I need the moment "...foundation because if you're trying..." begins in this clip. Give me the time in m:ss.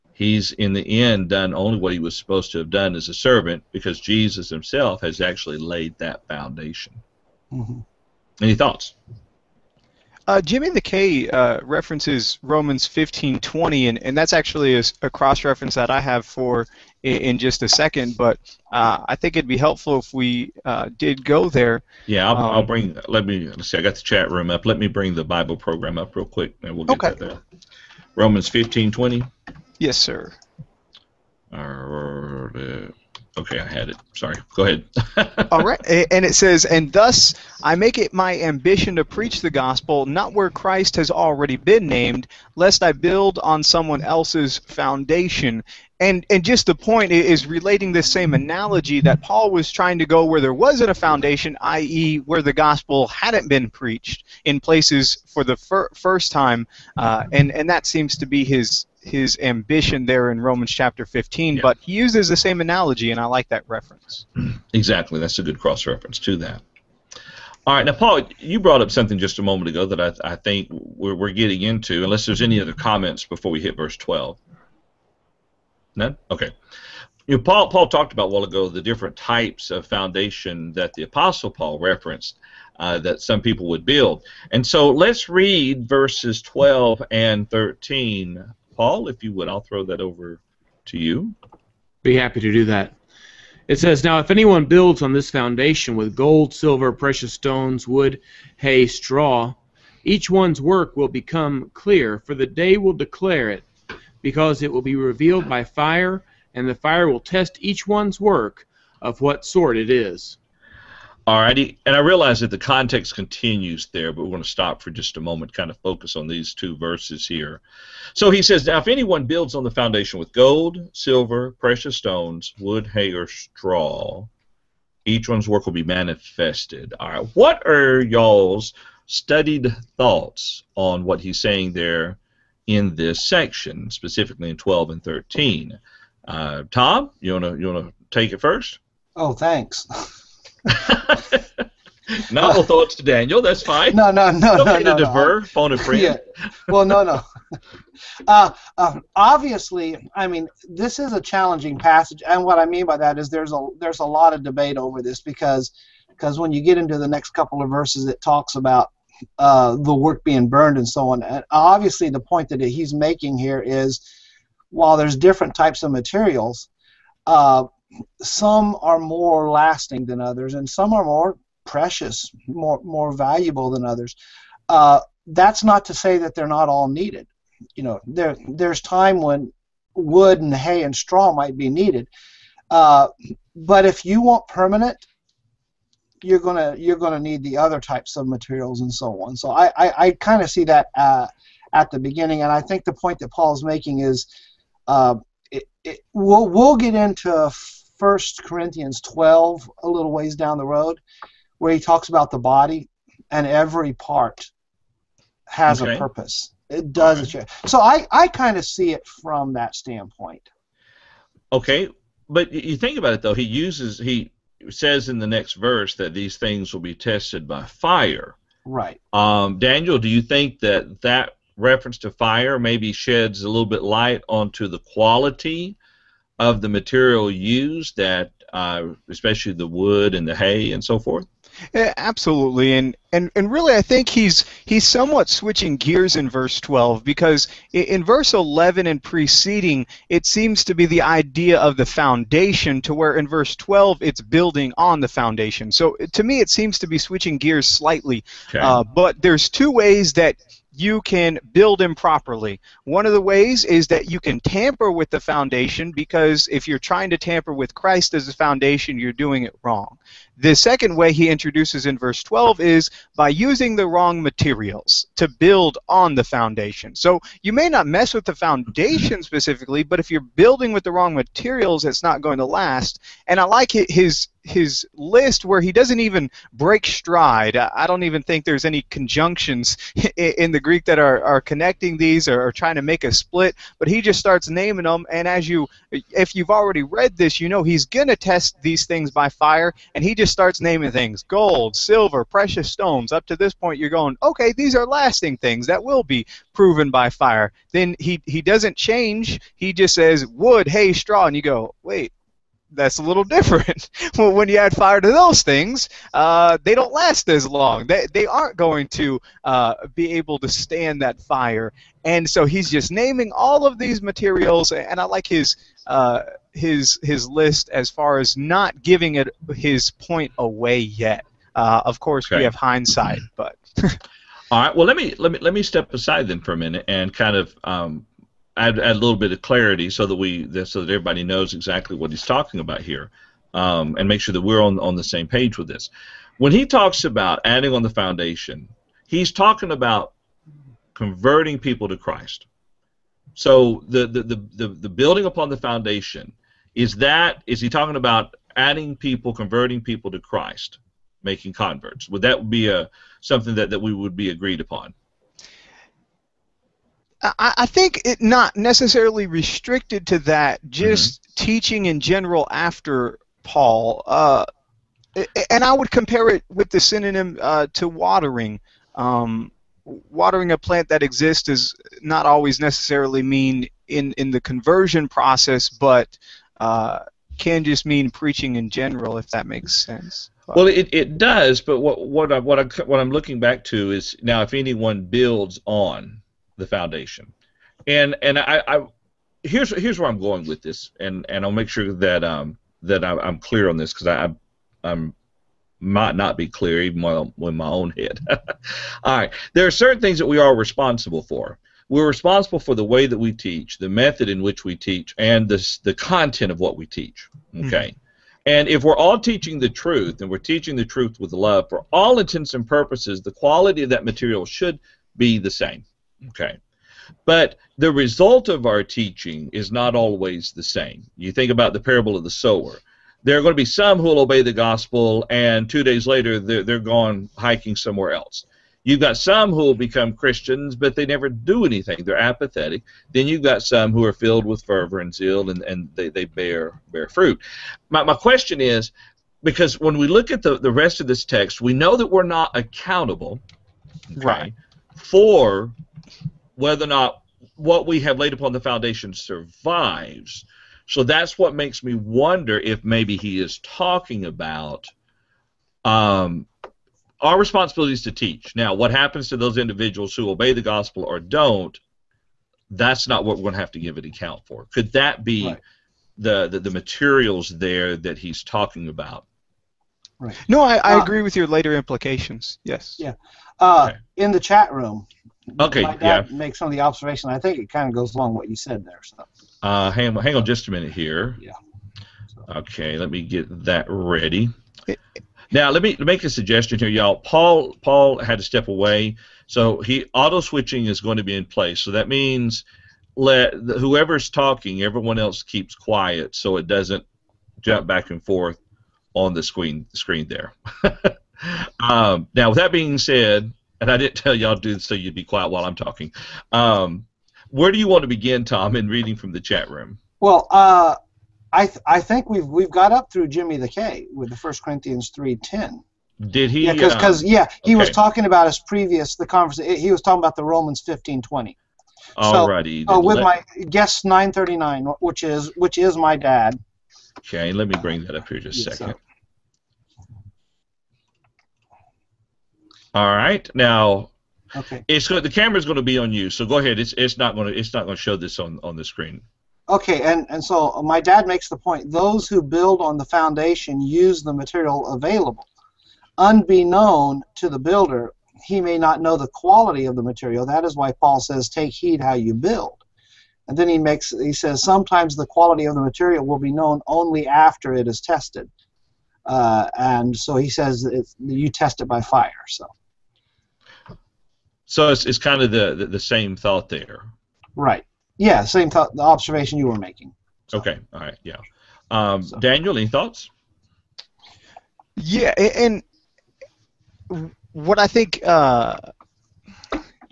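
4:15.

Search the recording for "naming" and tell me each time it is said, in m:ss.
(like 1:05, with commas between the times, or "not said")
4:44, 4:50, 5:12.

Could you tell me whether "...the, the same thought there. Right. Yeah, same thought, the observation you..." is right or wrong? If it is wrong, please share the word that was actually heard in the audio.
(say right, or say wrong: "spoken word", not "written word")
right.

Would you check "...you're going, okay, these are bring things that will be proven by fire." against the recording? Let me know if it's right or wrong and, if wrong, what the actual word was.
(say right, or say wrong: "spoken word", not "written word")
wrong: "lasting", not "bring".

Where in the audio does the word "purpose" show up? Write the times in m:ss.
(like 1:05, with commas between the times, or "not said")
3:25, 6:52.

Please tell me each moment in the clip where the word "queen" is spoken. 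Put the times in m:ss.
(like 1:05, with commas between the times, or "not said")
not said.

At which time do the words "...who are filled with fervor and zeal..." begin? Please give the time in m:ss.
7:13.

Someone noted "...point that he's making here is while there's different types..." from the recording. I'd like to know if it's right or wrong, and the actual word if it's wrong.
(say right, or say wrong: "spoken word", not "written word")
right.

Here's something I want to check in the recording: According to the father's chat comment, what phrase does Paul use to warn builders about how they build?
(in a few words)
Take heed how you build.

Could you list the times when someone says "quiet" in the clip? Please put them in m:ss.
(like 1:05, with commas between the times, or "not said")
8:15, 8:25.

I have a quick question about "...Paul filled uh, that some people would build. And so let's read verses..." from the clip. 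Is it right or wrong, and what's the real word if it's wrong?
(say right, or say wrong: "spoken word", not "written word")
wrong: "referenced", not "filled".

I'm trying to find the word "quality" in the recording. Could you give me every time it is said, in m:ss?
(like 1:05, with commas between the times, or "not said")
3:44, 6:53, 9:09, 9:15.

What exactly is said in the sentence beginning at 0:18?
But uh, I think it'd be helpful if we uh, did go there.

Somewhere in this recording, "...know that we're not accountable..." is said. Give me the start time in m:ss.
7:21.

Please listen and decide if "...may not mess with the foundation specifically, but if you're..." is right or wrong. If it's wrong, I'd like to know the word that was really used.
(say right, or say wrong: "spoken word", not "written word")
right.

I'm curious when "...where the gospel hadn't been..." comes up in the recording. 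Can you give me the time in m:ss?
0:52.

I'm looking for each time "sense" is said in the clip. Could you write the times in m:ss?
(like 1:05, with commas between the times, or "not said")
6:19.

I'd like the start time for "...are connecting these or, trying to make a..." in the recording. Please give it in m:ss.
4:41.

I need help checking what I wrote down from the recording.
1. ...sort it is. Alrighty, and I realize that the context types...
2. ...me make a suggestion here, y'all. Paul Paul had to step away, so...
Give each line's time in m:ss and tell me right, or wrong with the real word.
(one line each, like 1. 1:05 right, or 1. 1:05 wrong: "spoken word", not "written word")
1. 1:49 wrong: "continues", not "types"
2. 8:05 right.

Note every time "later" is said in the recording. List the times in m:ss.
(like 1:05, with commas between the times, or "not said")
7:06, 7:51.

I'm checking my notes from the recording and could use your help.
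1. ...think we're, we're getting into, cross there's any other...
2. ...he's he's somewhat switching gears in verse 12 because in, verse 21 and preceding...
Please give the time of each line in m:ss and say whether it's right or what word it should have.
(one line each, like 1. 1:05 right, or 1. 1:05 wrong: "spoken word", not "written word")
1. 1:10 wrong: "unless", not "cross"
2. 3:54 wrong: "11", not "21".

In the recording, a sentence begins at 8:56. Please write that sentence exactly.
It's it's not going to it's not going to show this on on the screen.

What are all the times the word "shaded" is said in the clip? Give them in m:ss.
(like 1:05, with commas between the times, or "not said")
not said.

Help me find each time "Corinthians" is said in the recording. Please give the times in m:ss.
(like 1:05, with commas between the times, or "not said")
3:18, 8:34.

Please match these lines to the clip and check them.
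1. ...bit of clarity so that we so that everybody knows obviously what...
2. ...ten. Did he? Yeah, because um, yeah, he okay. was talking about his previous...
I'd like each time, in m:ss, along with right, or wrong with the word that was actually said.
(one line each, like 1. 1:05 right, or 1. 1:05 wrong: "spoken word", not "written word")
1. 5:29 wrong: "exactly", not "obviously"
2. 8:35 right.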